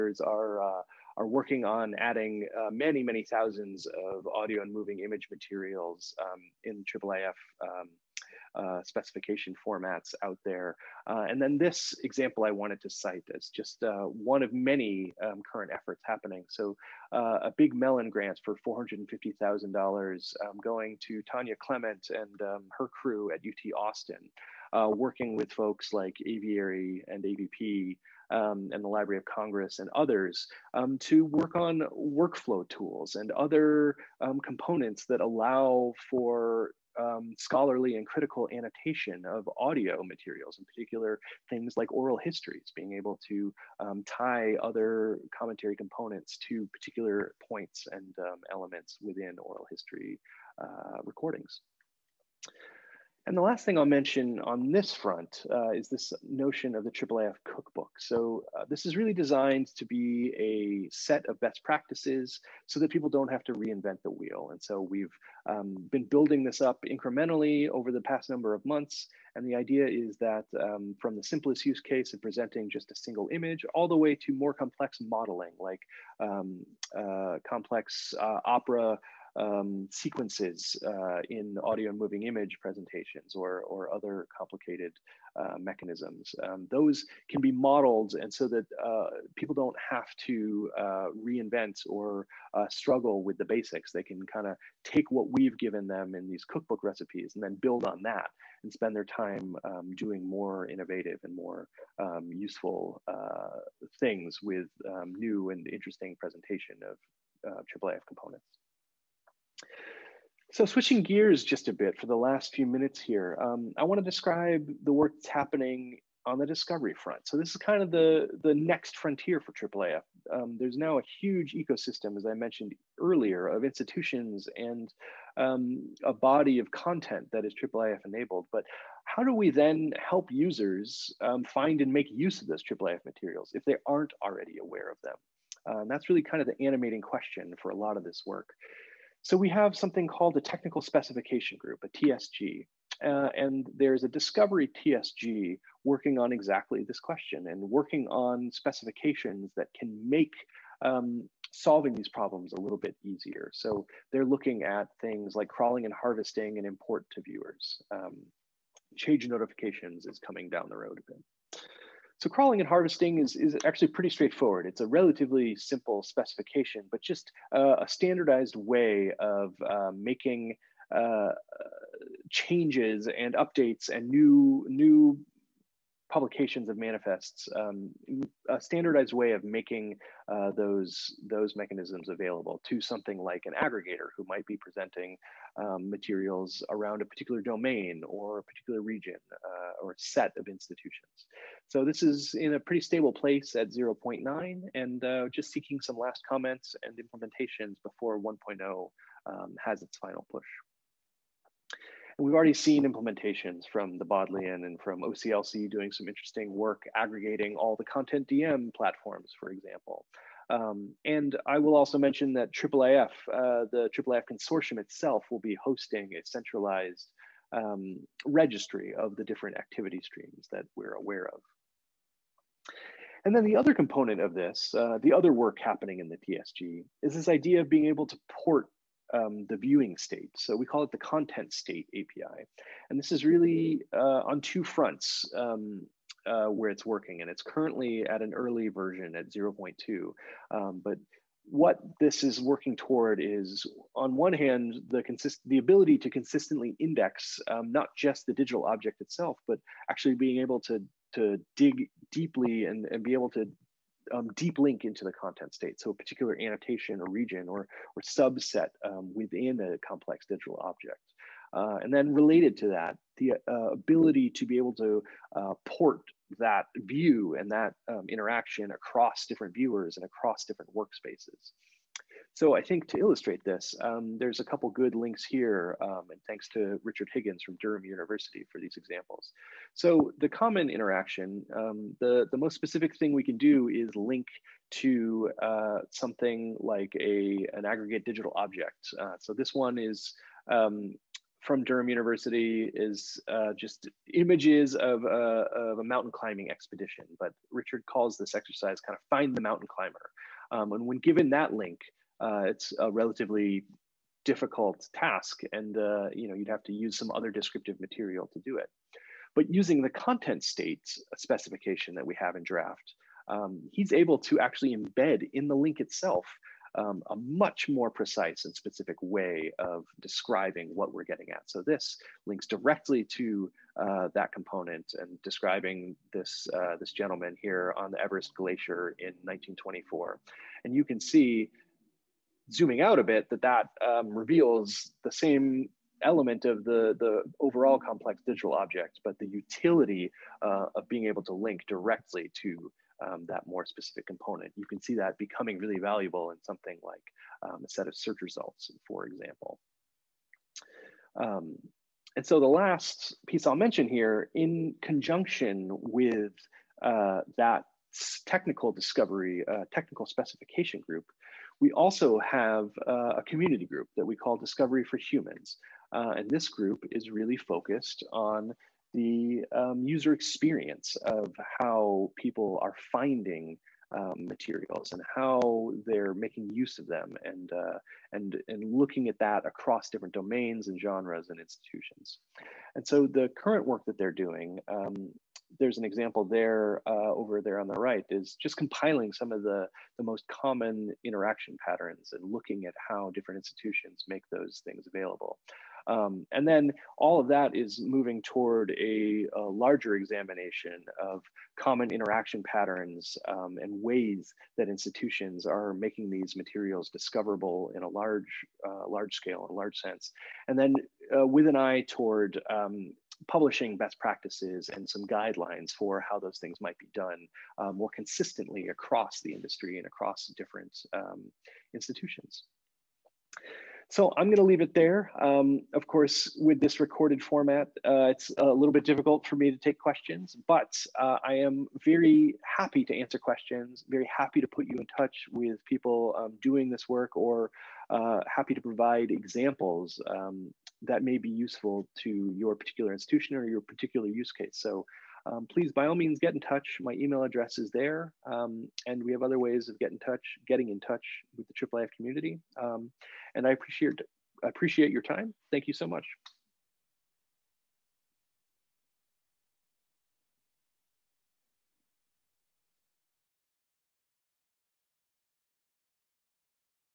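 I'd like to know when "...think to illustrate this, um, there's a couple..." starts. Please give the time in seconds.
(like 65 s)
272 s.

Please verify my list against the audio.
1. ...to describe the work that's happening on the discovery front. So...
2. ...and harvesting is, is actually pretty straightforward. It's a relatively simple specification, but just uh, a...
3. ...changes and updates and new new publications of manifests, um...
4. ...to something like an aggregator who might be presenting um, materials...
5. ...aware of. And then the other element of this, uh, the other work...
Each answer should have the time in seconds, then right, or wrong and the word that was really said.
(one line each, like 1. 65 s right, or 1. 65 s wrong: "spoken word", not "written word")
1. 113 s right
2. 162 s right
3. 172 s right
4. 182 s right
5. 220 s wrong: "component", not "element".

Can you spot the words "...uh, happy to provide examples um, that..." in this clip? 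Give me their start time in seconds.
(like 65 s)
437 s.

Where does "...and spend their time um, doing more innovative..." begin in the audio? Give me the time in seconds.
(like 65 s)
98 s.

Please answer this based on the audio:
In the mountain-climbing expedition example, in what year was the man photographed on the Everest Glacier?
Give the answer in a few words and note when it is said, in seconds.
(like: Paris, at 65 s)
1924, at 329 s.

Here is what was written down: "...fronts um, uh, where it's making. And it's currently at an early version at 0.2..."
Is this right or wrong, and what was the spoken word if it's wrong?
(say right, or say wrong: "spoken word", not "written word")
wrong: "working", not "making".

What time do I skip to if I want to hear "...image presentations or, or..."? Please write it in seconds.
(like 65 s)
82 s.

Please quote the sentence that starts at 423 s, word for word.
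So I'm going to leave it there.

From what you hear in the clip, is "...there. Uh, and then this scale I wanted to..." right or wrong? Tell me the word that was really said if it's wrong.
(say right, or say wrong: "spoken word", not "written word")
wrong: "example", not "scale".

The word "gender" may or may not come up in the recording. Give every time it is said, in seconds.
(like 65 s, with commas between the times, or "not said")
not said.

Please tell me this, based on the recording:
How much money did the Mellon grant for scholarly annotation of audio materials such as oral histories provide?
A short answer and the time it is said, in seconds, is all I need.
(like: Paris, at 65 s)
$450,000, at 18 s.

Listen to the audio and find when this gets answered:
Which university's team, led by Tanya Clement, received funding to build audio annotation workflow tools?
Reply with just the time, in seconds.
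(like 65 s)
23 s.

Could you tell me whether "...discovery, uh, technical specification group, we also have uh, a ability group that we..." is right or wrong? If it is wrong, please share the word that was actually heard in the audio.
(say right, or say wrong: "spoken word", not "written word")
wrong: "community", not "ability".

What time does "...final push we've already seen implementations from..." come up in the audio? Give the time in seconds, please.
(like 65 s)
199 s.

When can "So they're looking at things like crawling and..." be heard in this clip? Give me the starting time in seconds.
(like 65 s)
153 s.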